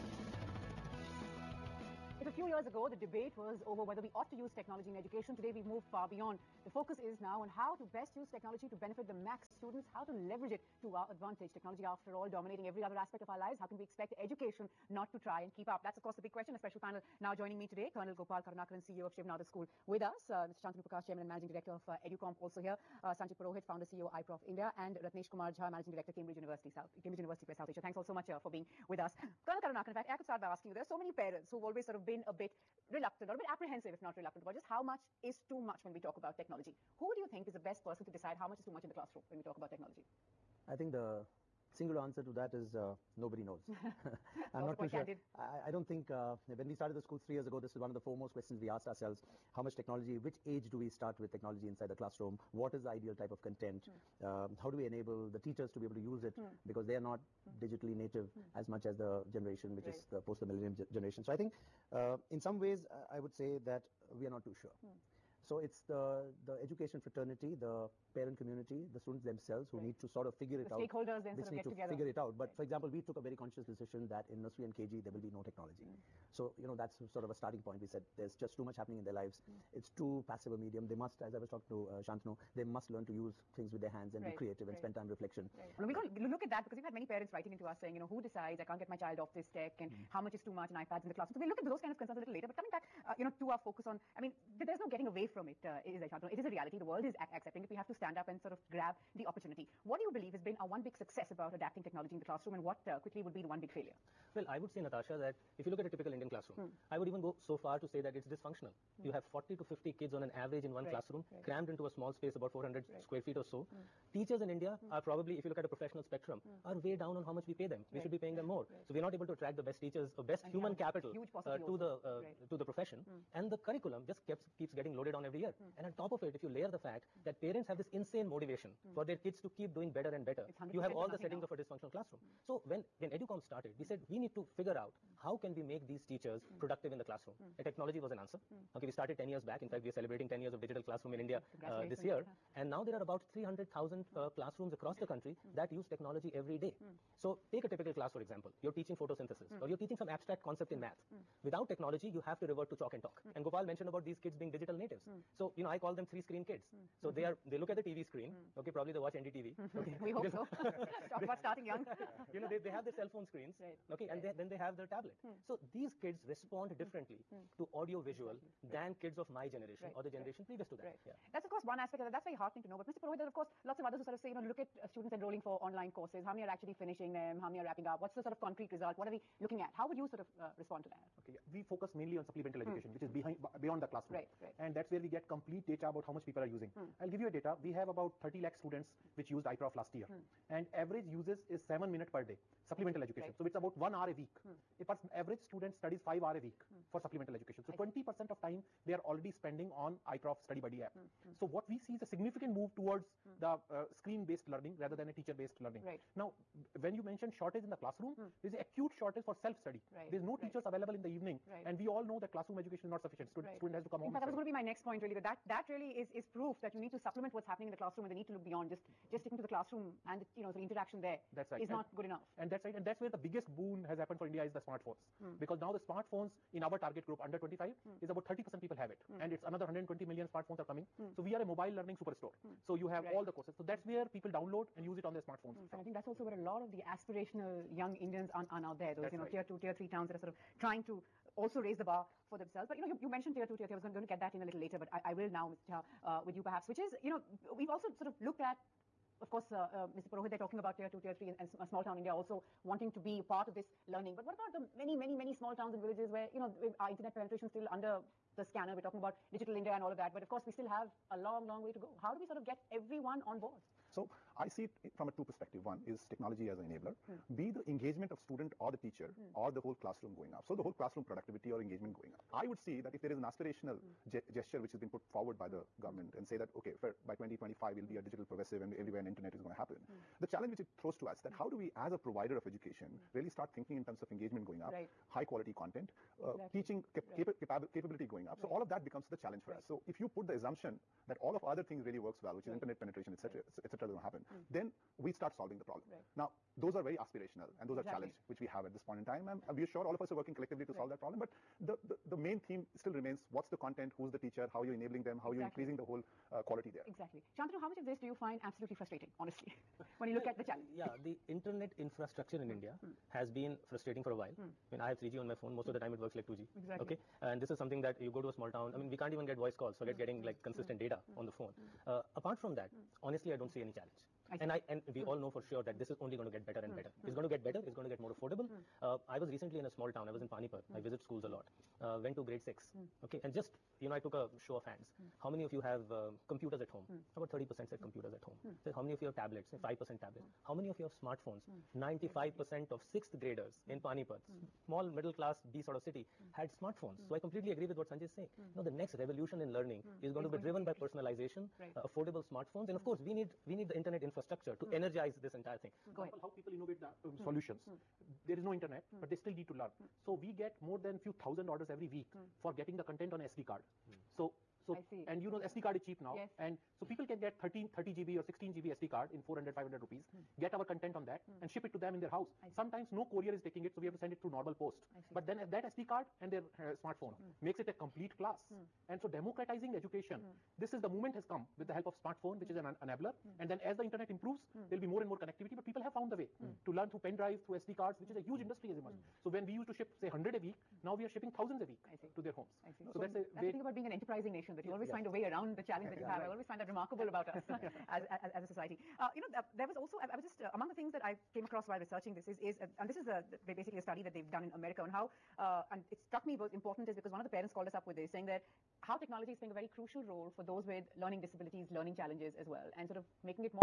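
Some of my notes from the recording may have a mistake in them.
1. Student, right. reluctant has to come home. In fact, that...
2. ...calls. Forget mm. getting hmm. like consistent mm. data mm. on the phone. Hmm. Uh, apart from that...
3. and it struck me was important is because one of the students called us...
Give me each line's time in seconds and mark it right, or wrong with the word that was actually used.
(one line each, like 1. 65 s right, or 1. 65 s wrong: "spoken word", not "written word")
1. 213 s wrong: "student", not "reluctant"
2. 319 s right
3. 405 s wrong: "parents", not "students".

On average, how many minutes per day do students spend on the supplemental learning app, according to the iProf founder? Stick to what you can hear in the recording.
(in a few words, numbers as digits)
7 minutes.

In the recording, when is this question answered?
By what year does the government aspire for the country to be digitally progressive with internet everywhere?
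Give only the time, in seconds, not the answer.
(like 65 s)
277 s.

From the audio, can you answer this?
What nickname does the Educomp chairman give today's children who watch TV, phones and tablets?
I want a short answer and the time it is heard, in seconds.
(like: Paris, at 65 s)
three screen kids, at 156 s.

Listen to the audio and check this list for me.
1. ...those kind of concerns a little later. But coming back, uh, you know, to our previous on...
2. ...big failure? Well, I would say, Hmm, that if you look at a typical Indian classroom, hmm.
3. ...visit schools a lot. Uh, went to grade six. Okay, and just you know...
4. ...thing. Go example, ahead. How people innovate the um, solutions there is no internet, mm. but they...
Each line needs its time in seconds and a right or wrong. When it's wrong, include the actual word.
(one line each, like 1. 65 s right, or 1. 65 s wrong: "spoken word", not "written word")
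1. 91 s wrong: "focus", not "previous"
2. 103 s wrong: "Natasha", not "Hmm"
3. 330 s right
4. 355 s right.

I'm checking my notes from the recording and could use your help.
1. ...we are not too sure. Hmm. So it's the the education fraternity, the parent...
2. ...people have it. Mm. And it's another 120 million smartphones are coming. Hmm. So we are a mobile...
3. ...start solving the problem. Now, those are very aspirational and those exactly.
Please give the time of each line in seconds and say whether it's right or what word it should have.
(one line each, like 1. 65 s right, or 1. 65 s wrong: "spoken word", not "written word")
1. 64 s right
2. 228 s right
3. 295 s right.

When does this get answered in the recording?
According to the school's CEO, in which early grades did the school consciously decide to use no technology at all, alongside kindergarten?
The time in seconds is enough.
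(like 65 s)
74 s.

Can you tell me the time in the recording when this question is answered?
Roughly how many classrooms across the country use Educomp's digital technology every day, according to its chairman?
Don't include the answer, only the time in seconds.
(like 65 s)
143 s.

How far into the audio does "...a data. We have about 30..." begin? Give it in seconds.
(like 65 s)
187 s.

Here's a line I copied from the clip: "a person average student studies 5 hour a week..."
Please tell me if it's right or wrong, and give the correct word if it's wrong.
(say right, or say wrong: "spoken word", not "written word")
right.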